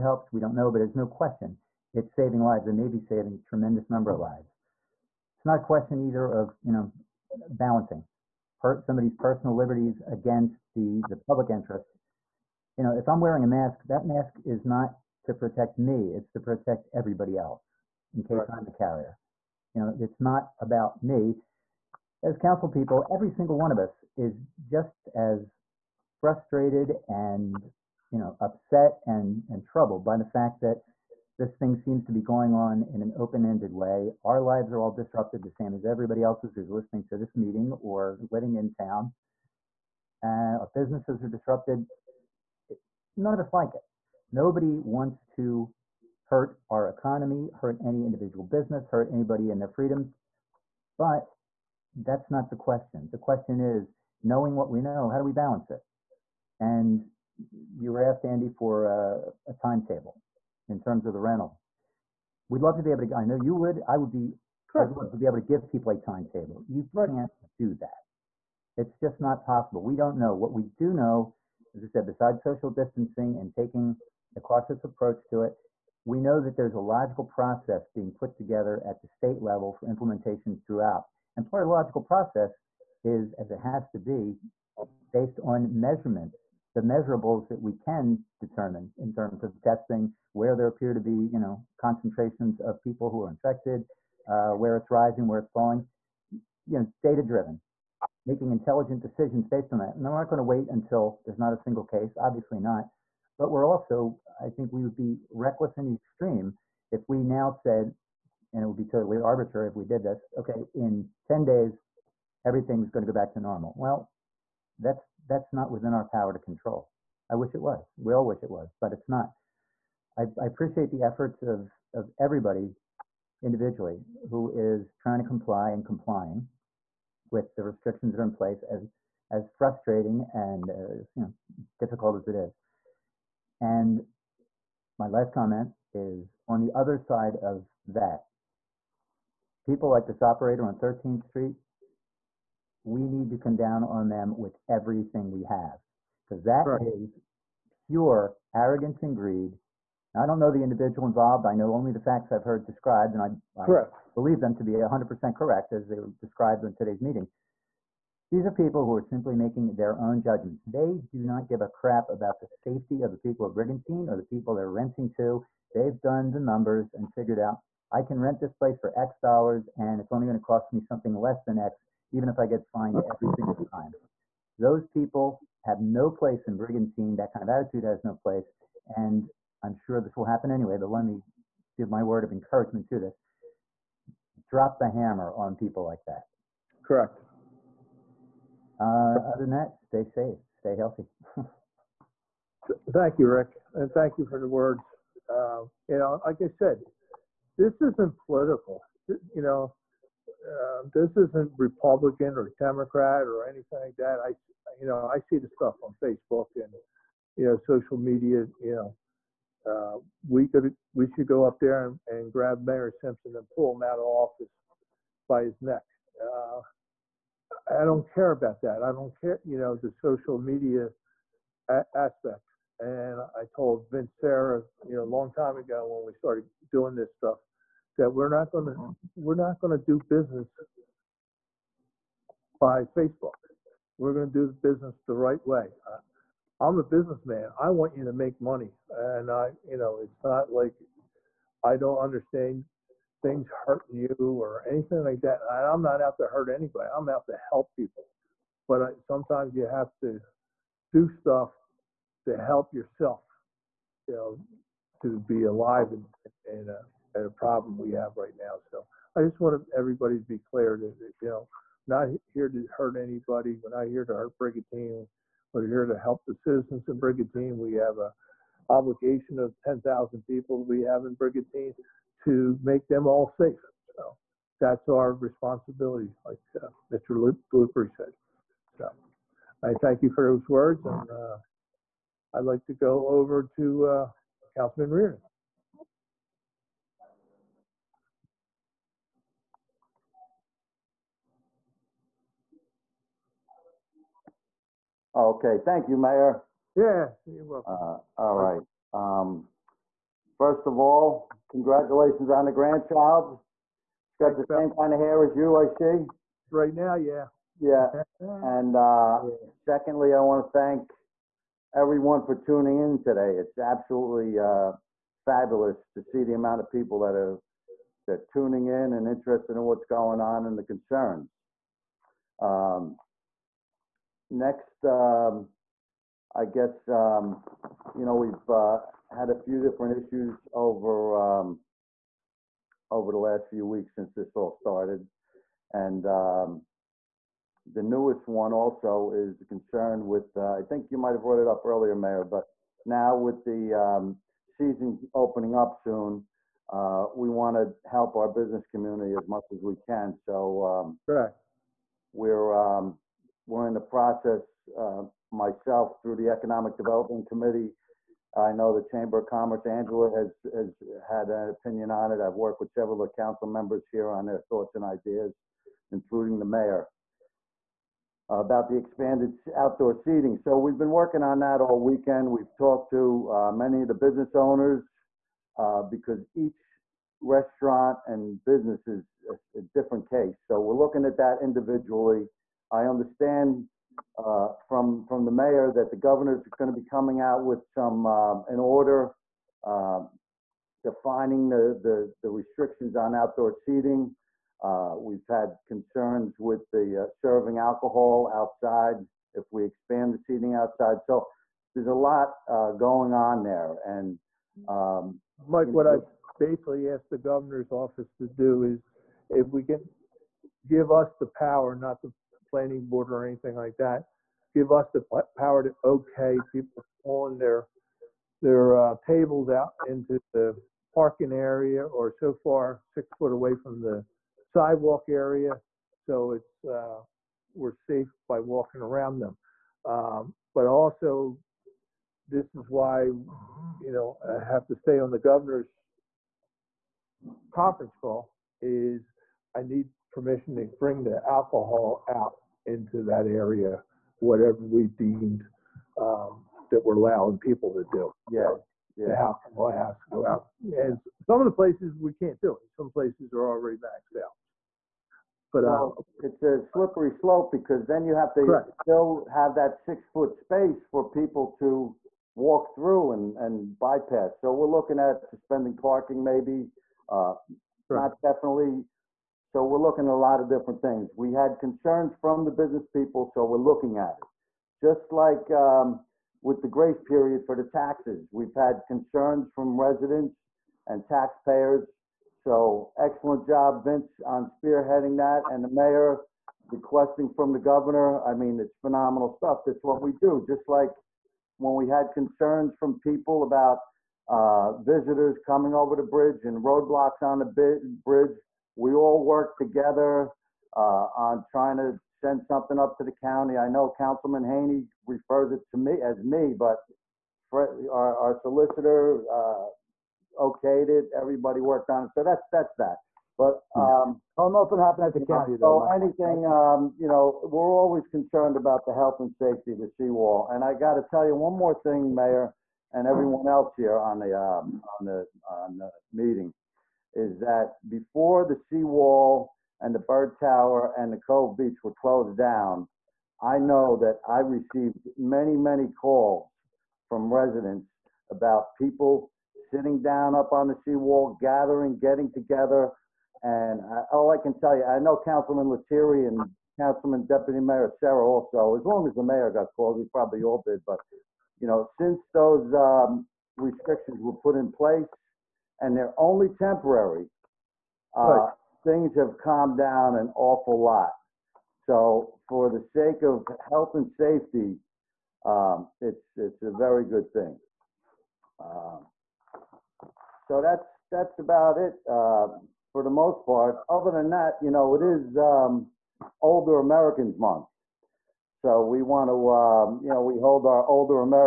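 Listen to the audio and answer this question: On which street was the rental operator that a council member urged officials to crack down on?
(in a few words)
13th Street.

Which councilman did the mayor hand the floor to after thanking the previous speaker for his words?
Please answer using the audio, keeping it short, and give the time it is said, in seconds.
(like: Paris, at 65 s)
Riordan, at 284 s.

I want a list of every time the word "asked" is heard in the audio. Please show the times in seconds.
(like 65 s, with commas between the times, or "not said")
58 s, 406 s.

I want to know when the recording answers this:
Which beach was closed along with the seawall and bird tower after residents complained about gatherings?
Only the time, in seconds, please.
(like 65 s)
531 s.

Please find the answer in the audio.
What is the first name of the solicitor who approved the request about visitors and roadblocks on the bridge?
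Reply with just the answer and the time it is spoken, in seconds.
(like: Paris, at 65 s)
Fred, at 507 s.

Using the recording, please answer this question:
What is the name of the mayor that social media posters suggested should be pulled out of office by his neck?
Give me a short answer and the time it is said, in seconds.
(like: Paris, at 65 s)
Mayor Simpson, at 212 s.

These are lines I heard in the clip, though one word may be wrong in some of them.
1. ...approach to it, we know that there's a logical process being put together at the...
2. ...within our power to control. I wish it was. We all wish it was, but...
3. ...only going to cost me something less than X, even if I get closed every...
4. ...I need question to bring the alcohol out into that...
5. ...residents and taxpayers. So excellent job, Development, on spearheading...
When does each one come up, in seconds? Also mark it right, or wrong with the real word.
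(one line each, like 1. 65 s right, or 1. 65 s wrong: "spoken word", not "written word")
1. 74 s right
2. 115 s right
3. 170 s wrong: "fined", not "closed"
4. 439 s wrong: "permission", not "question"
5. 479 s wrong: "Vince", not "Development".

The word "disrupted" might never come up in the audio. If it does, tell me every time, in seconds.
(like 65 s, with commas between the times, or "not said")
34 s, 41 s.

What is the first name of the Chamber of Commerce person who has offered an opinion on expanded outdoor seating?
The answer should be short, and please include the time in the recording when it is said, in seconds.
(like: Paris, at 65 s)
Angela, at 359 s.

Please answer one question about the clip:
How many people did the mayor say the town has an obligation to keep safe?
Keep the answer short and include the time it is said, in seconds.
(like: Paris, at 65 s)
10,000, at 269 s.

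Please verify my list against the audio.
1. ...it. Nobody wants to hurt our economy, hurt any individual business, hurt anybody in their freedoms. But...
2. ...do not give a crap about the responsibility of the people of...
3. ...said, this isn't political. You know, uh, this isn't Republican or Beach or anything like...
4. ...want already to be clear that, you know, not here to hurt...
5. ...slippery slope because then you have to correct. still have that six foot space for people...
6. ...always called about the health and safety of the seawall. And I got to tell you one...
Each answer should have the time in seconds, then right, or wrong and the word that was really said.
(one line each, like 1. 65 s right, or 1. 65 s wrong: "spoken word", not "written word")
1. 43 s right
2. 161 s wrong: "safety", not "responsibility"
3. 196 s wrong: "Democrat", not "Beach"
4. 259 s wrong: "everybody", not "already"
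5. 456 s right
6. 517 s wrong: "concerned", not "called".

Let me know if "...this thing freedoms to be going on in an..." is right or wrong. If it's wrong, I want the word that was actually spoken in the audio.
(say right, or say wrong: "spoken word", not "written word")
wrong: "seems", not "freedoms".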